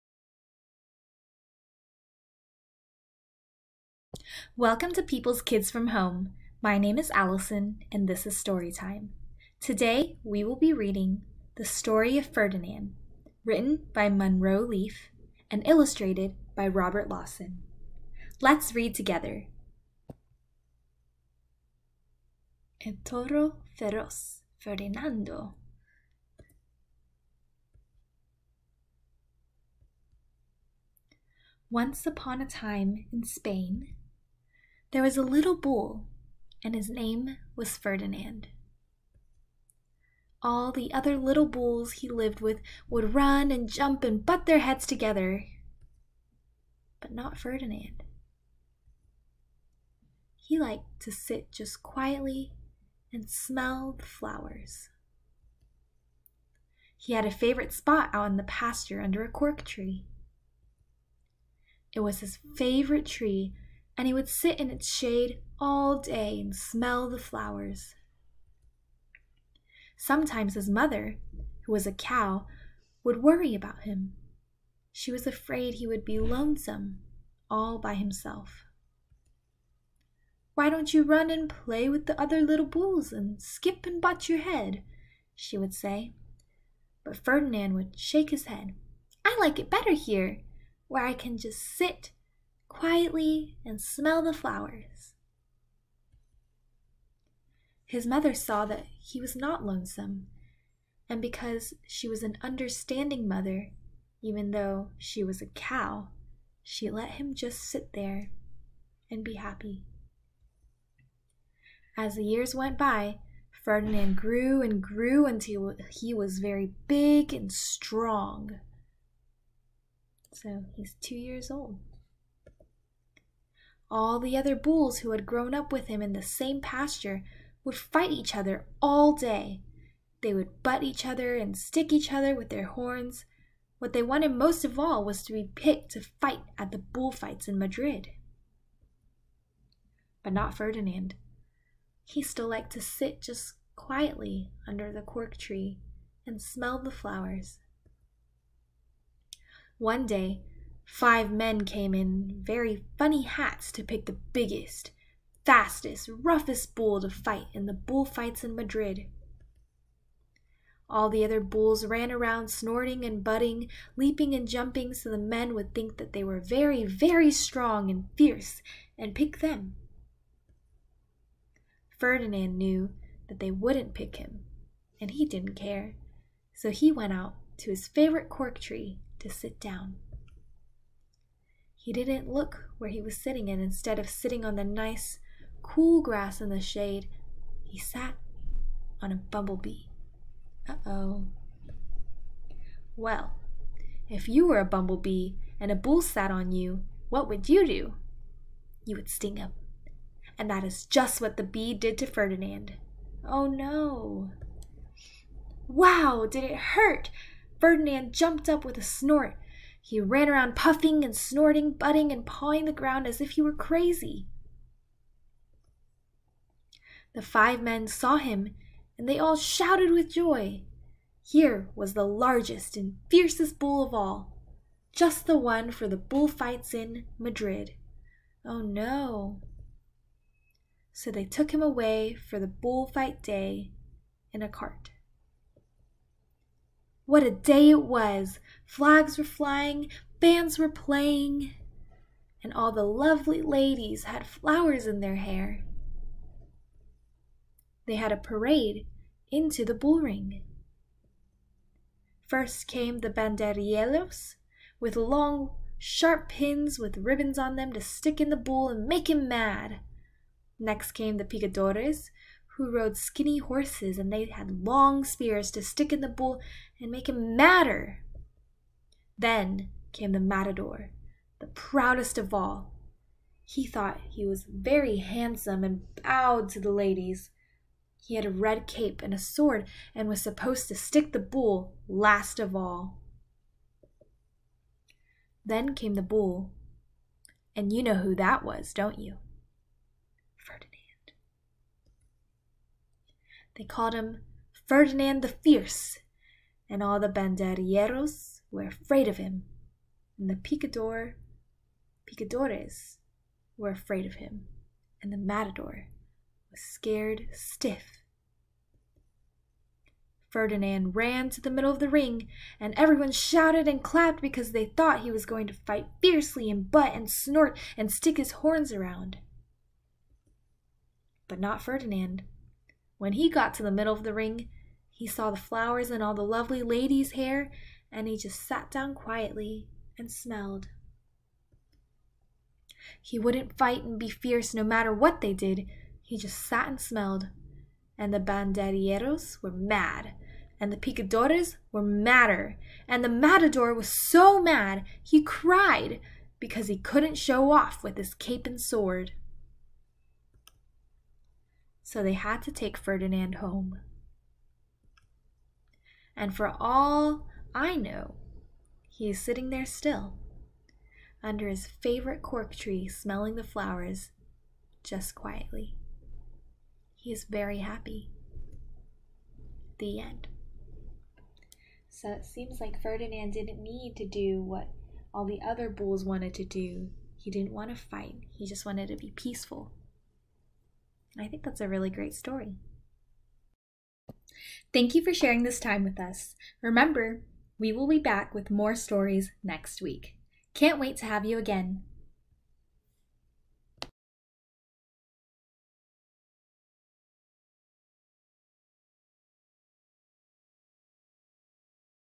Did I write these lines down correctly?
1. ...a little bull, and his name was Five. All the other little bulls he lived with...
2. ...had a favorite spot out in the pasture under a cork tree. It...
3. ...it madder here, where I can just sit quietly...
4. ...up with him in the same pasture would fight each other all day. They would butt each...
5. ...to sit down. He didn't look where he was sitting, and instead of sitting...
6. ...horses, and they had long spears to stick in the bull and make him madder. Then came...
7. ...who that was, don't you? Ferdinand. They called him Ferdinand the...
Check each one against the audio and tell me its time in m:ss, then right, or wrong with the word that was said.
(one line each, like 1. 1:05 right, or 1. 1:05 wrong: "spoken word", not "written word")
1. 0:35 wrong: "Ferdinand", not "Five"
2. 0:57 right
3. 1:29 wrong: "better", not "madder"
4. 2:05 right
5. 2:59 right
6. 4:23 right
7. 4:47 right.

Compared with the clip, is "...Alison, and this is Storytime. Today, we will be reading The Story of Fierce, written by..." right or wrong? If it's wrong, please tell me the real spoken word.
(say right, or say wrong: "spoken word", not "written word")
wrong: "Ferdinand", not "Fierce".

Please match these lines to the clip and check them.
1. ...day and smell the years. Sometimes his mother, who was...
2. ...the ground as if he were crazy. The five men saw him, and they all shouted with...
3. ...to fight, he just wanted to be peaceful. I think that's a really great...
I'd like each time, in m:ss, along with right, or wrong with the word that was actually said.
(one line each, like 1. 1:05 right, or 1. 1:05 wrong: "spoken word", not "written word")
1. 1:05 wrong: "flowers", not "years"
2. 3:32 right
3. 6:17 right.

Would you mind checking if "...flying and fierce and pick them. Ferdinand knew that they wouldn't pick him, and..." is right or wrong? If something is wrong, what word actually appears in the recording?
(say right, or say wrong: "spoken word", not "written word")
wrong: "strong", not "flying".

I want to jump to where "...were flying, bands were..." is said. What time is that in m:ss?
3:59.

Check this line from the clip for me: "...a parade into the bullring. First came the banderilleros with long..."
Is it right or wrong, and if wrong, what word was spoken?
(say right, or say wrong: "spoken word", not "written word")
right.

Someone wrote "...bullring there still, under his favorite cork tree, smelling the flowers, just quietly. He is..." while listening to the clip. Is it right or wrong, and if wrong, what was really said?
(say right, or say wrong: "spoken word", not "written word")
wrong: "sitting", not "bullring".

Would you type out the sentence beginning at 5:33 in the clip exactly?
He wouldn't fight and be fierce no matter what they did.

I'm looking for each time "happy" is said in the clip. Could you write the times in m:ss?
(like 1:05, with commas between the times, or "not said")
1:49, 6:07.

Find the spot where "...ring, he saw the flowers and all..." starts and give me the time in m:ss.
5:24.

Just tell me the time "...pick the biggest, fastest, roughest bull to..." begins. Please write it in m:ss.
2:33.